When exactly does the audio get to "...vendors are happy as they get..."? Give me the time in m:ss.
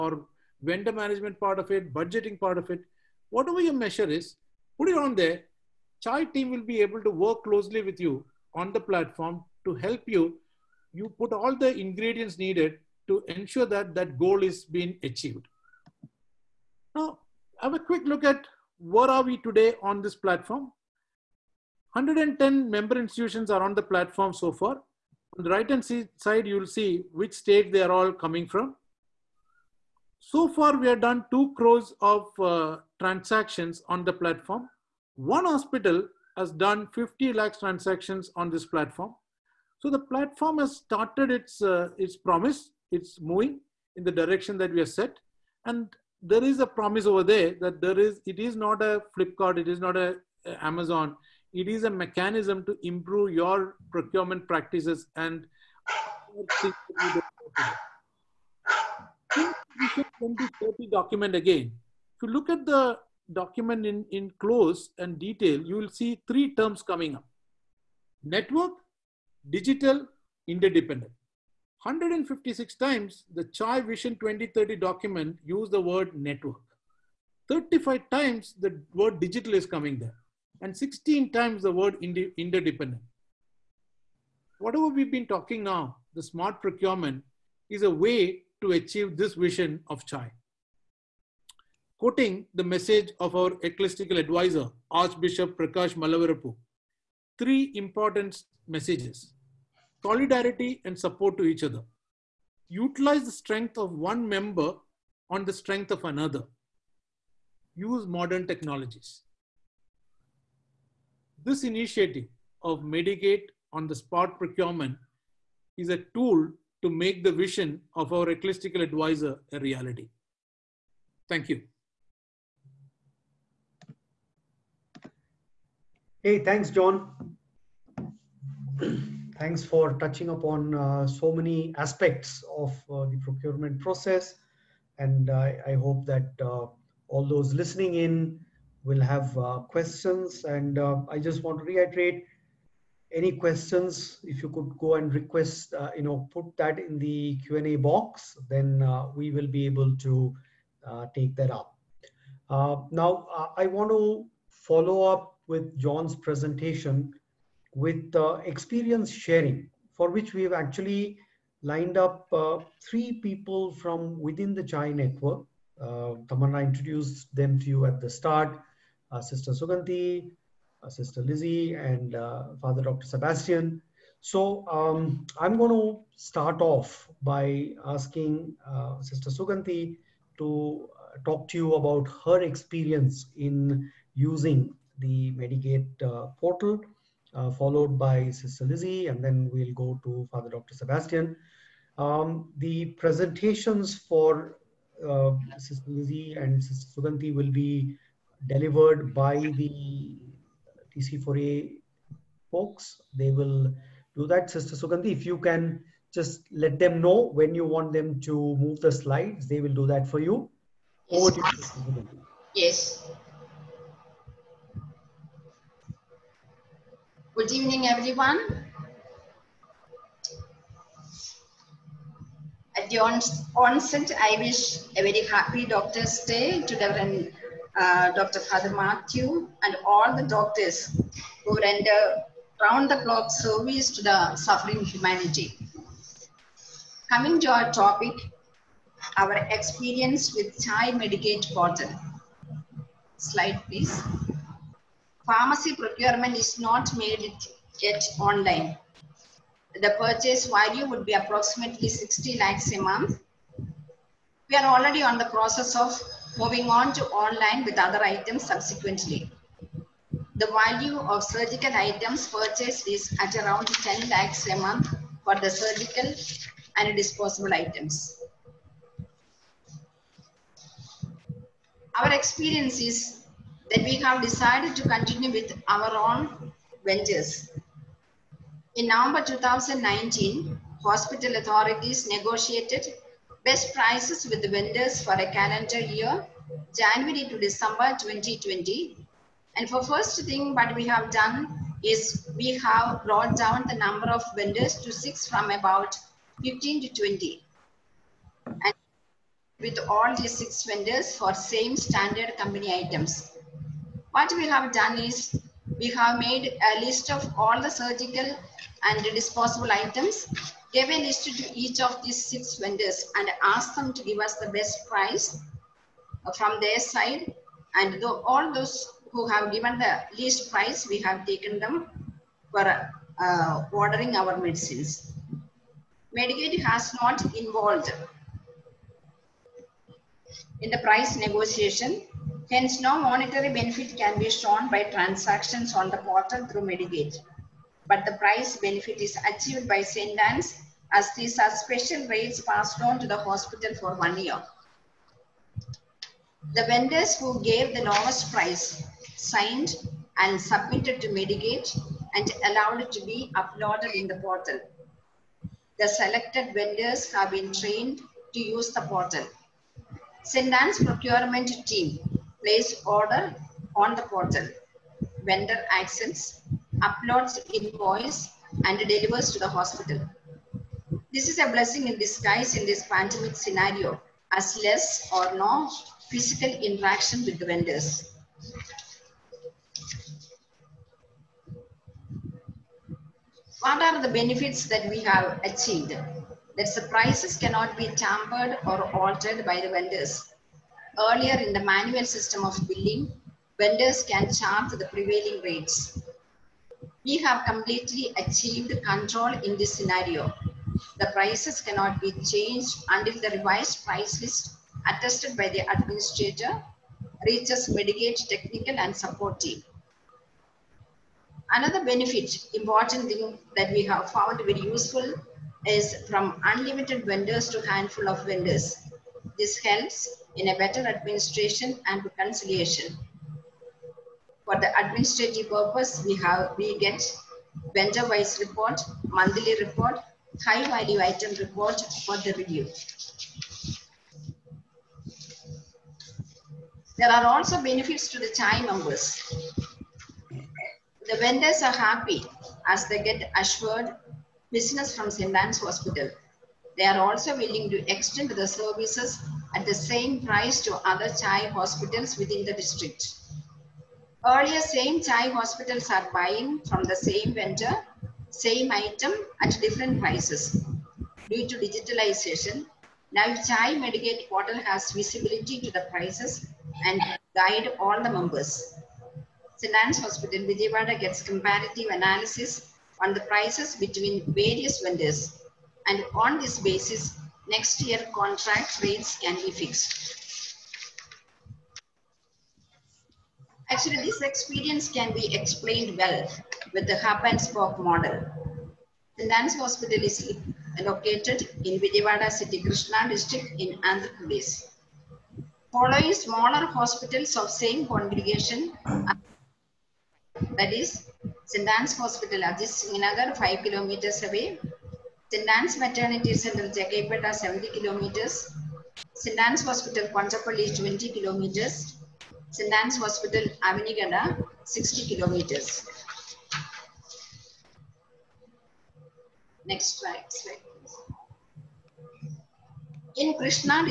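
7:21.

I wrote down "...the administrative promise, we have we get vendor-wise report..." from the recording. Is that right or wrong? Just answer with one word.
wrong.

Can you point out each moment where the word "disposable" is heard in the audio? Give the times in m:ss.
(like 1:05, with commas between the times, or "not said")
4:26, 5:09.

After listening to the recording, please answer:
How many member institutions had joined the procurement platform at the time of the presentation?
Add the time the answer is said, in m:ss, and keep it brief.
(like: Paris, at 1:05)
110, at 0:21.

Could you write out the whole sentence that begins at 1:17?
35 times the word digital is coming there and 16 times the word interdependent.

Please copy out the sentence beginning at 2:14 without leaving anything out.
And I, I hope that uh, all those listening in will have uh, questions.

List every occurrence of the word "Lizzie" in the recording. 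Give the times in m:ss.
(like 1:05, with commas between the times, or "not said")
2:51, 3:08, 3:15.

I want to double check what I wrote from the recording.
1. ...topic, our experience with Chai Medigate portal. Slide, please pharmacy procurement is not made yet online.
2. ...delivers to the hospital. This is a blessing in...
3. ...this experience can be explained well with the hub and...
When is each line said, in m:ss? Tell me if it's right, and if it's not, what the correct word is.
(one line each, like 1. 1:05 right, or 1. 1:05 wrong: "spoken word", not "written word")
1. 3:57 right
2. 6:08 right
3. 8:03 right.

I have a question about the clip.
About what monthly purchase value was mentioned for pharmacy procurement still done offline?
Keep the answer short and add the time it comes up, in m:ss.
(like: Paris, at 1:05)
60 lakhs, at 4:11.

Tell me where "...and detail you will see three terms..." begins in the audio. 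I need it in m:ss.
1:04.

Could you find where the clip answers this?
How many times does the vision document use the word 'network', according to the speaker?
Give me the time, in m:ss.
1:11.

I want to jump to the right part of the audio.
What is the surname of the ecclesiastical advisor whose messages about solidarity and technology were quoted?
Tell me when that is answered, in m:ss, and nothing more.
1:35.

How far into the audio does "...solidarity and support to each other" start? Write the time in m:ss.
1:40.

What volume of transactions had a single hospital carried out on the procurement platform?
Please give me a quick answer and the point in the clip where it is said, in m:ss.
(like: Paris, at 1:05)
50 lakhs, at 0:36.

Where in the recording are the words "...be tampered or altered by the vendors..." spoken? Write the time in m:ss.
6:27.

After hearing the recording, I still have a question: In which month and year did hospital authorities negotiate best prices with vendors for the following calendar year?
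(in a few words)
November 2019.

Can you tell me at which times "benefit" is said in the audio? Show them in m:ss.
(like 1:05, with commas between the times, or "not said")
5:33, 5:38, 6:24, 6:51, 7:17.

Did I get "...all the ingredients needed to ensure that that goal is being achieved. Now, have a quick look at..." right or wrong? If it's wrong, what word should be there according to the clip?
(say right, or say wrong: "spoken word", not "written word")
right.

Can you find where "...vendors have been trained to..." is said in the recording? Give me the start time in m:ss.
5:56.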